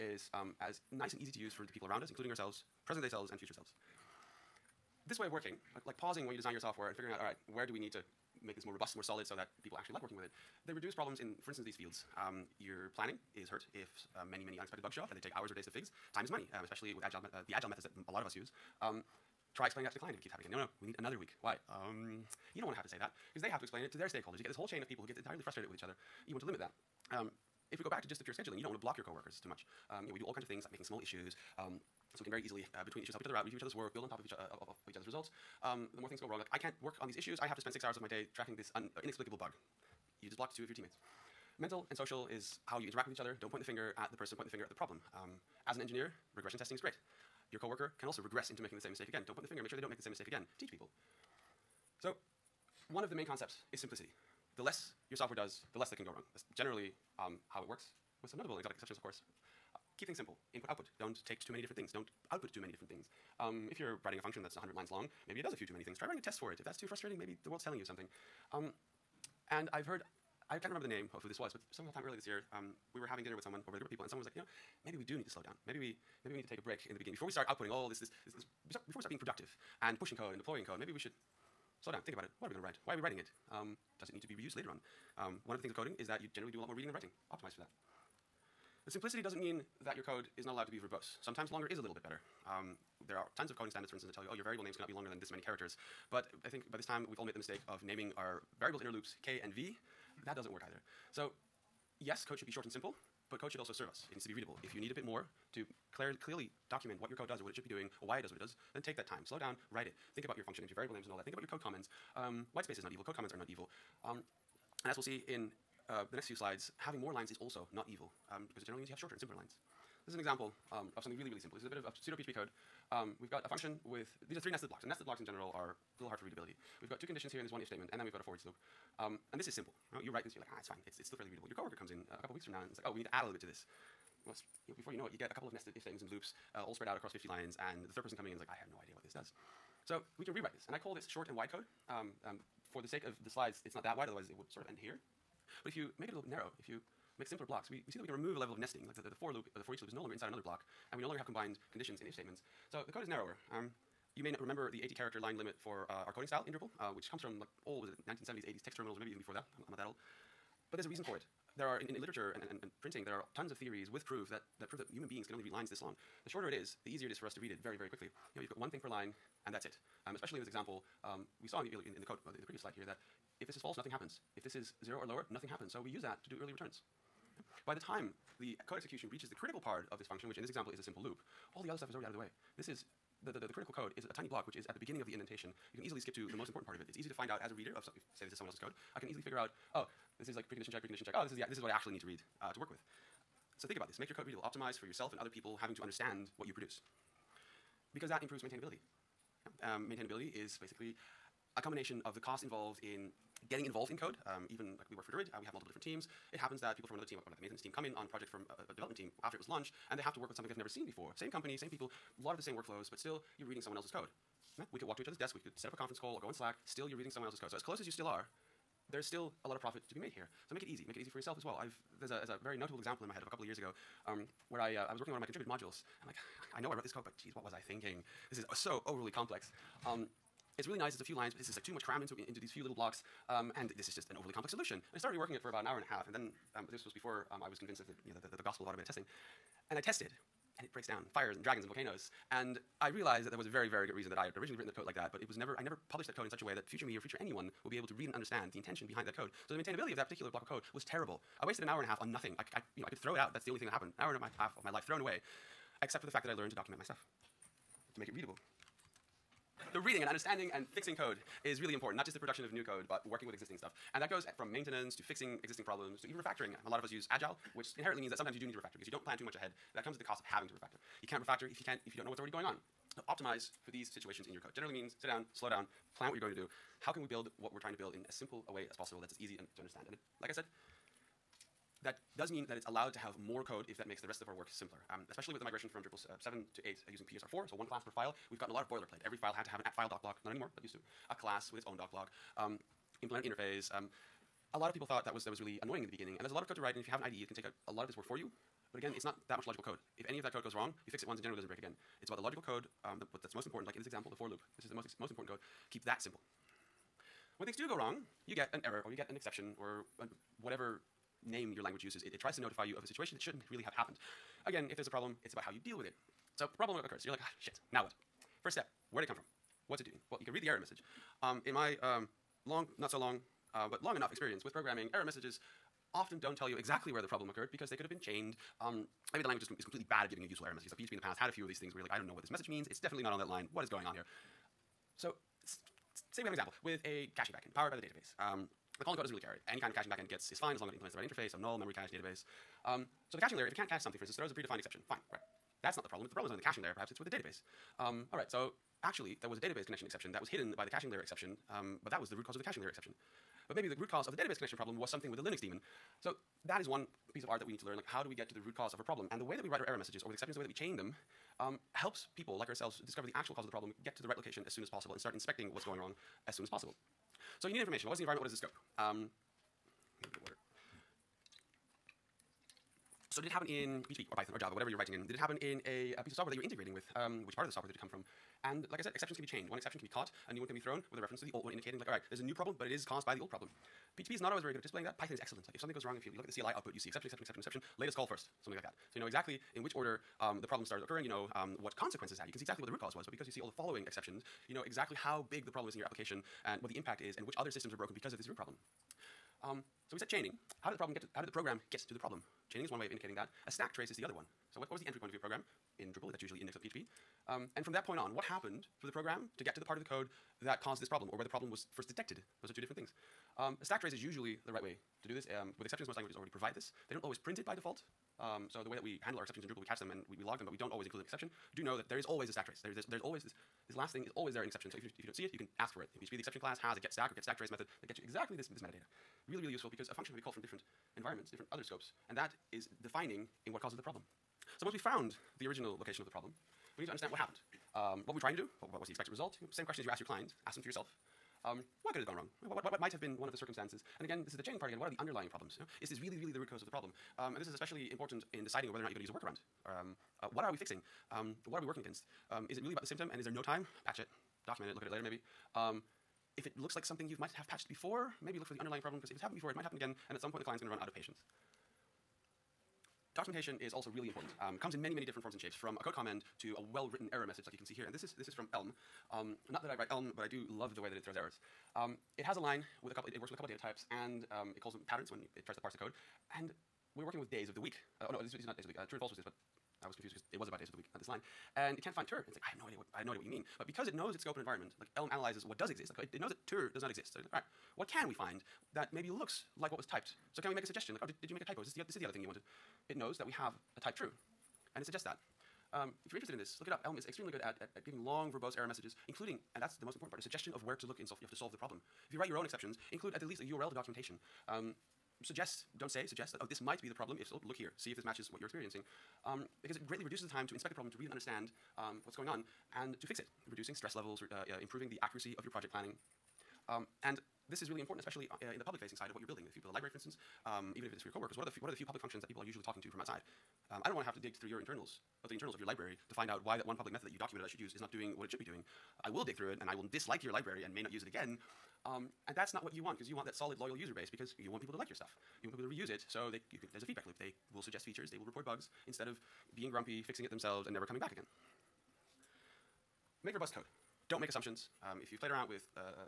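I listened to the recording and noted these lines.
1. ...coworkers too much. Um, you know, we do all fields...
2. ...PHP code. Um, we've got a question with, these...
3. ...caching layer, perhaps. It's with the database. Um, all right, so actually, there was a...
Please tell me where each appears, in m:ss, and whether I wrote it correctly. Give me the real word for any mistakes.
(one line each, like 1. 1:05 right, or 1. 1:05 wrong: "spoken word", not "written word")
1. 0:29 wrong: "kinds", not "fields"
2. 2:02 wrong: "function", not "question"
3. 5:46 right.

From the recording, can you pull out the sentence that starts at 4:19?
So reading and understanding and fixing code is really important, not just the production of new code, but working with existing stuff.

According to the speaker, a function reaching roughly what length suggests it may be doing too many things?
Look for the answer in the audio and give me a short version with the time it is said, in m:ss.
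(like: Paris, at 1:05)
100 lines, at 1:04.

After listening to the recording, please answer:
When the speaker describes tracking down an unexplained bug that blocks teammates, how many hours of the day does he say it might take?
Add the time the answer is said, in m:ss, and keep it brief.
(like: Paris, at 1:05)
6, at 0:37.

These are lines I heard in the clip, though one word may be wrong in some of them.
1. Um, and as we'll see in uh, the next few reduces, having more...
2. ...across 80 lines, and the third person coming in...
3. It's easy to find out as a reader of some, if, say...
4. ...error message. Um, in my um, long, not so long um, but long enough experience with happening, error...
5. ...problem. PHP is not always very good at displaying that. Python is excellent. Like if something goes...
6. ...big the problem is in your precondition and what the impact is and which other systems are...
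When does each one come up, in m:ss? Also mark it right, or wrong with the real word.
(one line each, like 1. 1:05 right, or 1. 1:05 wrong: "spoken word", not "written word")
1. 1:54 wrong: "slides", not "reduces"
2. 2:16 wrong: "50", not "80"
3. 3:06 right
4. 5:20 wrong: "programming", not "happening"
5. 6:23 right
6. 6:35 wrong: "application", not "precondition".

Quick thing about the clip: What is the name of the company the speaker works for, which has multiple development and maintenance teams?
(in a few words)
Druid.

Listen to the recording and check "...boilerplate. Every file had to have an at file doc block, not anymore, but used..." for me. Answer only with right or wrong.
right.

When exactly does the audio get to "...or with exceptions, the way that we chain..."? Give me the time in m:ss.
6:00.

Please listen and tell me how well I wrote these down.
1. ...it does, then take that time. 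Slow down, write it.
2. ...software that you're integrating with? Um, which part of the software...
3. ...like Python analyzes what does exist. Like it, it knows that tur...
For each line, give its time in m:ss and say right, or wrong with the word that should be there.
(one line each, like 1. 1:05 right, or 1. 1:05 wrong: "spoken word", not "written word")
1. 1:48 right
2. 6:16 right
3. 8:04 wrong: "Elm", not "Python".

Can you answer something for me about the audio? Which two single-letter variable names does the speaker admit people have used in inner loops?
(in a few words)
K and V.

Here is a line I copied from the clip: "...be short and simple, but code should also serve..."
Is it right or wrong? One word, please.
right.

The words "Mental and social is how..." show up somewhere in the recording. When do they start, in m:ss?
0:41.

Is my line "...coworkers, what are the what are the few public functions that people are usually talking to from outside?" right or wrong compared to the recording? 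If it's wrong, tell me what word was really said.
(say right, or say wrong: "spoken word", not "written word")
right.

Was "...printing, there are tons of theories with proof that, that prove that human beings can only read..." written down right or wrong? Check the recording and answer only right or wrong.
right.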